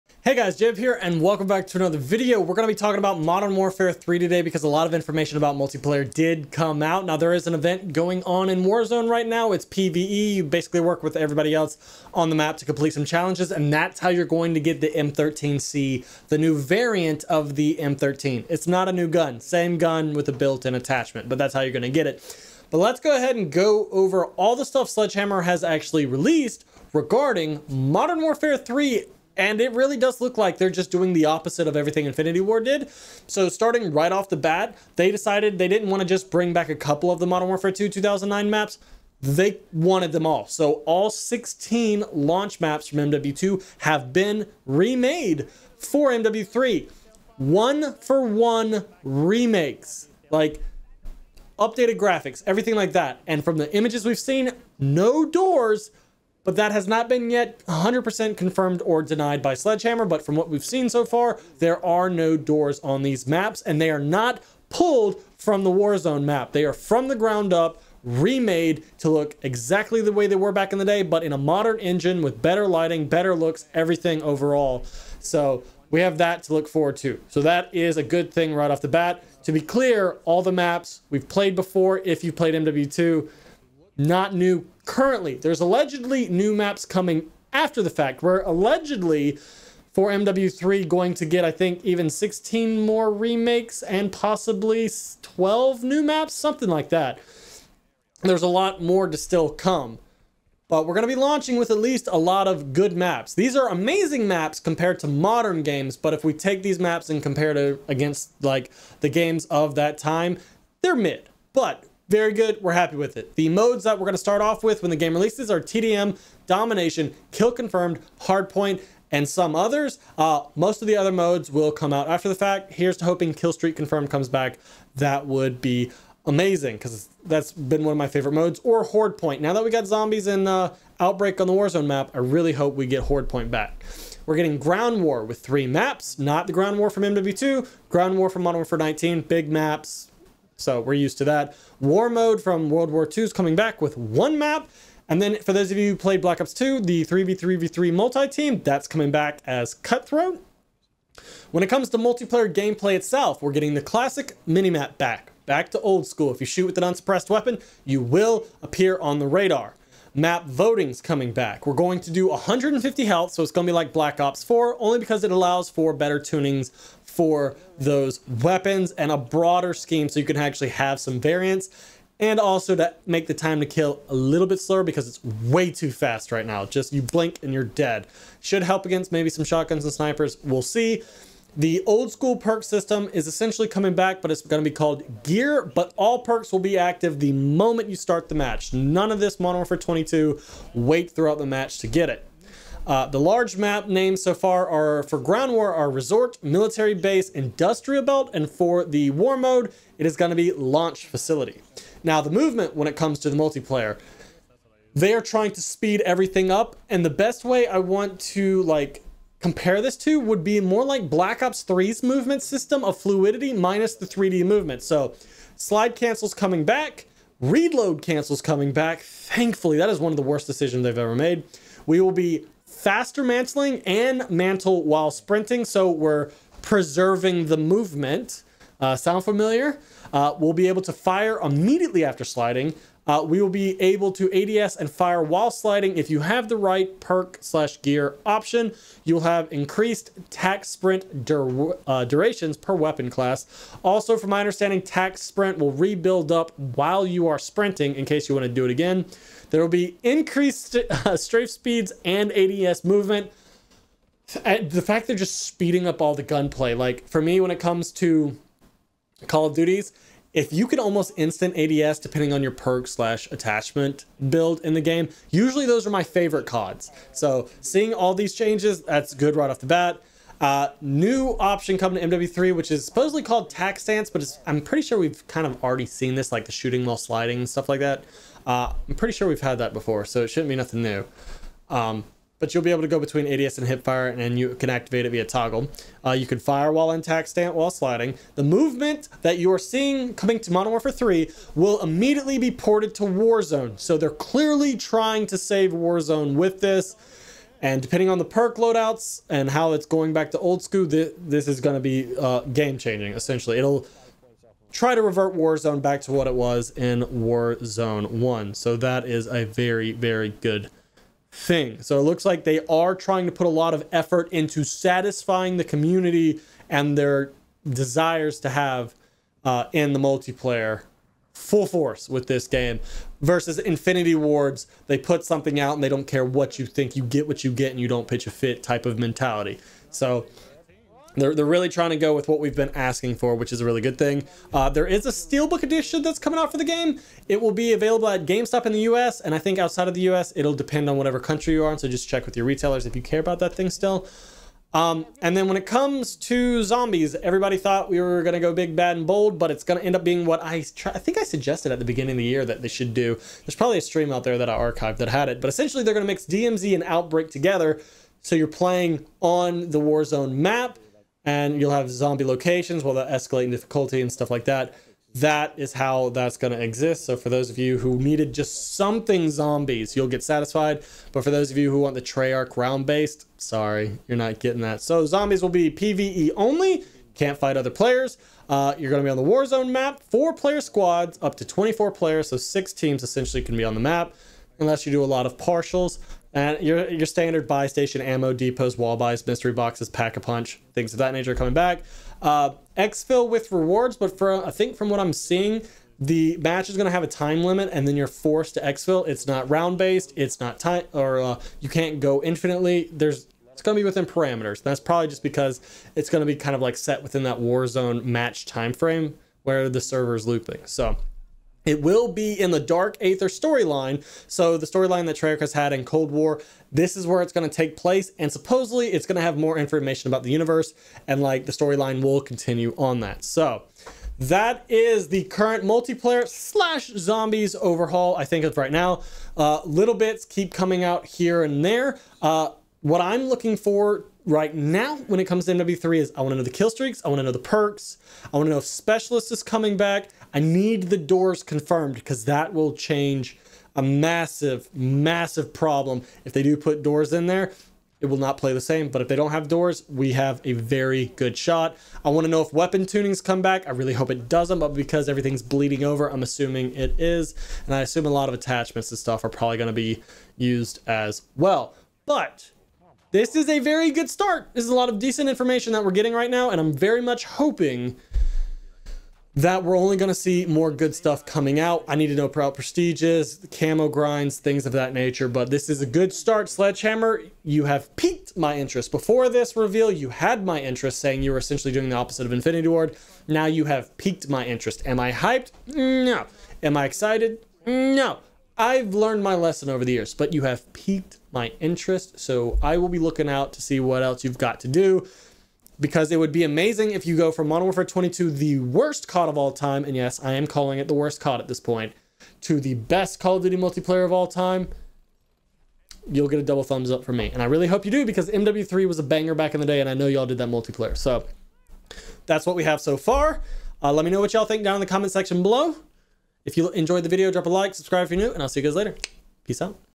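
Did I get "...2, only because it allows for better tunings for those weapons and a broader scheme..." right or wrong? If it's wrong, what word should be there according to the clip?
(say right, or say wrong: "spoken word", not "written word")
wrong: "4", not "2".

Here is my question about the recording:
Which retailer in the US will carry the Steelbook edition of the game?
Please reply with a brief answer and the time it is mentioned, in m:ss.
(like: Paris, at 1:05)
GameStop, at 5:38.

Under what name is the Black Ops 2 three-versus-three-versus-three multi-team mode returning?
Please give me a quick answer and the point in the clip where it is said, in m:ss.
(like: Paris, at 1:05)
Cutthroat, at 2:29.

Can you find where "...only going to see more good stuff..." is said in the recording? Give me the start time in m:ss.
7:49.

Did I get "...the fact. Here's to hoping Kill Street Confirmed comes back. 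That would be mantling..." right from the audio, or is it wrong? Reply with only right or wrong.
wrong.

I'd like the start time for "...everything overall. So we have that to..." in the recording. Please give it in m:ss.
1:13.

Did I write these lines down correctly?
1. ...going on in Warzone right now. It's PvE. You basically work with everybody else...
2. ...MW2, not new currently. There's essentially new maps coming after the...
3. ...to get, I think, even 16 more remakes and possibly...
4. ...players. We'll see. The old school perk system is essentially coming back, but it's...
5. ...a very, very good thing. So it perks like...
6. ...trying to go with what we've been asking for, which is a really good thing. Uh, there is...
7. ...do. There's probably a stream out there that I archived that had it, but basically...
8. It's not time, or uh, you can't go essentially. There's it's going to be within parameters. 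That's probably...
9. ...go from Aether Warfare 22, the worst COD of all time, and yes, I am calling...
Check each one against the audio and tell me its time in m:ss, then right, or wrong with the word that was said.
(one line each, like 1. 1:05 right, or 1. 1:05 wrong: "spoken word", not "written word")
1. 0:07 right
2. 1:22 wrong: "allegedly", not "essentially"
3. 1:31 right
4. 2:59 wrong: "snipers", not "players"
5. 5:09 wrong: "looks", not "perks"
6. 5:31 right
7. 5:52 wrong: "essentially", not "basically"
8. 6:40 wrong: "infinitely", not "essentially"
9. 8:17 wrong: "Modern", not "Aether".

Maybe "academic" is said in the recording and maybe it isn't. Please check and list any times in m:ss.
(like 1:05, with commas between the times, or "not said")
not said.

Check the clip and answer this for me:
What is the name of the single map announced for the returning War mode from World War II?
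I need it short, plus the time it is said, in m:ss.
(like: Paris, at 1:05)
Launch Facility, at 3:20.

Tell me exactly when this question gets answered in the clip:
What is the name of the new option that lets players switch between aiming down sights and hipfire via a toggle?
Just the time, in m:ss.
4:33.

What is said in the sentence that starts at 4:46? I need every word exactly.
Uh, you can fire while intact, stand while sliding.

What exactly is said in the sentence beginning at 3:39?
Thankfully, that is one of the worst decisions they've ever made.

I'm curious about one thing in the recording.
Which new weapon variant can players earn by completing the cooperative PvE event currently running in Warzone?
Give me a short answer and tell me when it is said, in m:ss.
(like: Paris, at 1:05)
M13C, at 0:14.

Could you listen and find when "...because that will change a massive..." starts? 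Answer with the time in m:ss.
7:21.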